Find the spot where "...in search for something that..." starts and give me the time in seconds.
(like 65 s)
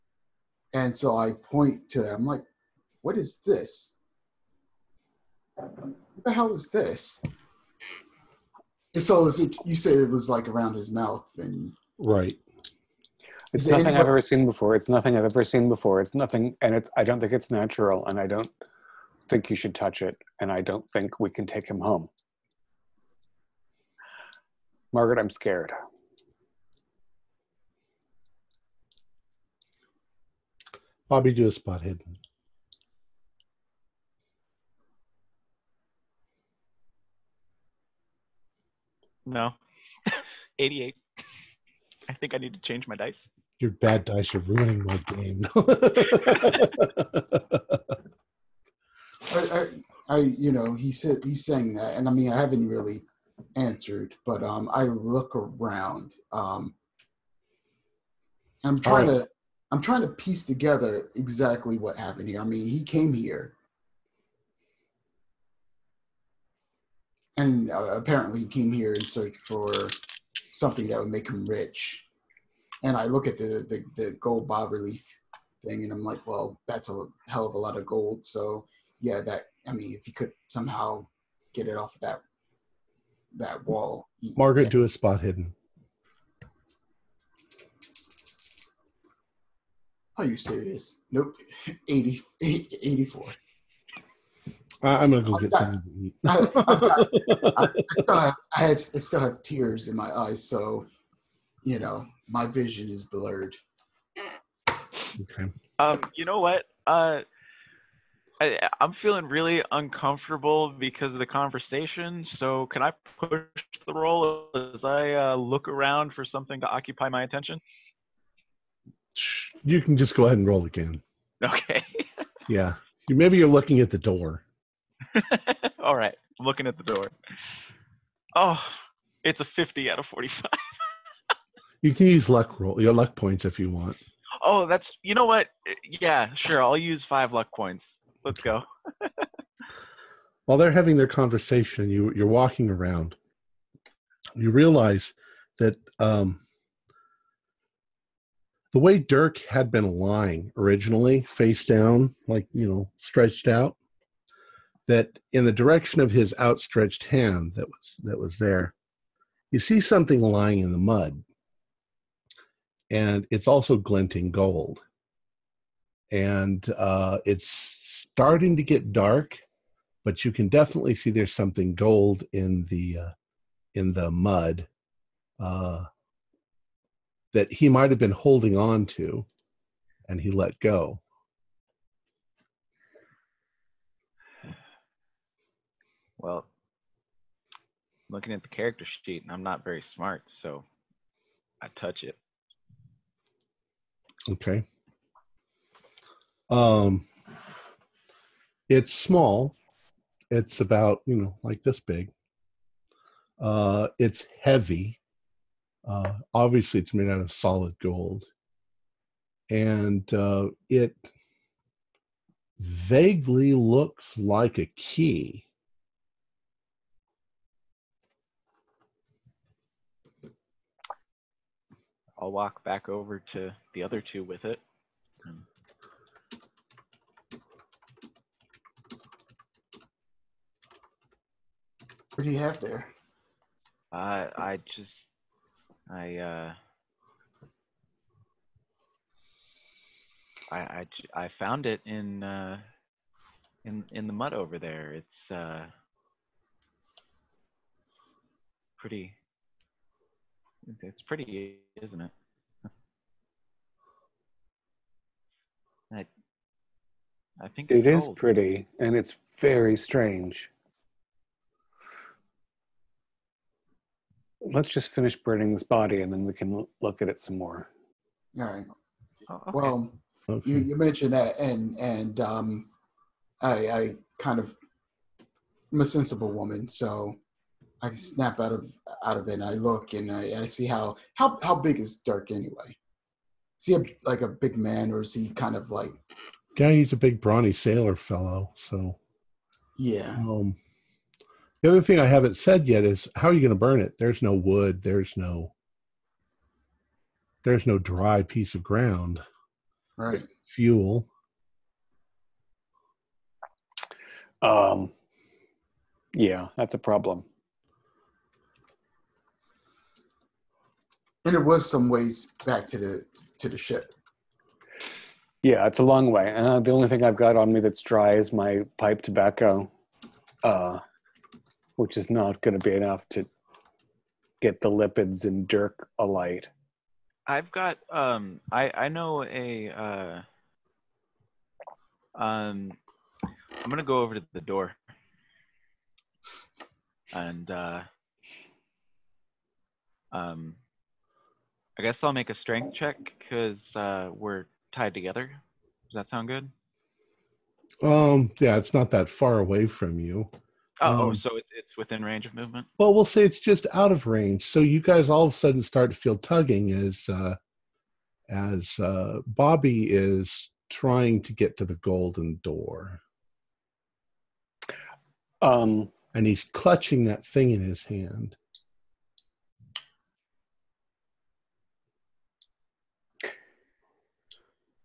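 68 s.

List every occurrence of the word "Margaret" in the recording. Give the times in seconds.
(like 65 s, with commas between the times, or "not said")
24 s, 84 s.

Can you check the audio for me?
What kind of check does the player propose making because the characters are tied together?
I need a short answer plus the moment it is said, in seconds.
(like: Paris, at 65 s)
Strength check, at 342 s.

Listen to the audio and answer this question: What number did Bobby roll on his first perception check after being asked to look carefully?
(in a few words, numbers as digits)
88.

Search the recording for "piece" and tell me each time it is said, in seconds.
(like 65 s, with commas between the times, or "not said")
60 s, 298 s.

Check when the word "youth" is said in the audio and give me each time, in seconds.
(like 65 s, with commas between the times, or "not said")
not said.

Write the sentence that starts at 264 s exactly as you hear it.
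let's just finish burning this body and then we can look at it some more.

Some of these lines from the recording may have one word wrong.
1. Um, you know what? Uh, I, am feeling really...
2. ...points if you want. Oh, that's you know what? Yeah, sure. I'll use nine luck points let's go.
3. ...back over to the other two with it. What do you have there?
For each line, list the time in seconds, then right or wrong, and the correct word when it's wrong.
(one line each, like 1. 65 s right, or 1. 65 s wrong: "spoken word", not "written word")
1. 105 s right
2. 133 s wrong: "five", not "nine"
3. 222 s right.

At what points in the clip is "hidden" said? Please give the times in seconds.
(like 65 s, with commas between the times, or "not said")
31 s, 85 s.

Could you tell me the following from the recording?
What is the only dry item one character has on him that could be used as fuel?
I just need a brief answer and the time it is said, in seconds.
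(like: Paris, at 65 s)
Pipe tobacco, at 318 s.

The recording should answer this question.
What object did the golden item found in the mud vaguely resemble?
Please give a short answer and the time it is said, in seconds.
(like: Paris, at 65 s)
A key, at 214 s.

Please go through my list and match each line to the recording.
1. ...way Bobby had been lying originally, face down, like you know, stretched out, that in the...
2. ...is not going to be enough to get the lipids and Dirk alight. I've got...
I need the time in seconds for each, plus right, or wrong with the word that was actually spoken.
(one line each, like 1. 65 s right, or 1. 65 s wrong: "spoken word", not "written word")
1. 148 s wrong: "Dirk", not "Bobby"
2. 321 s right.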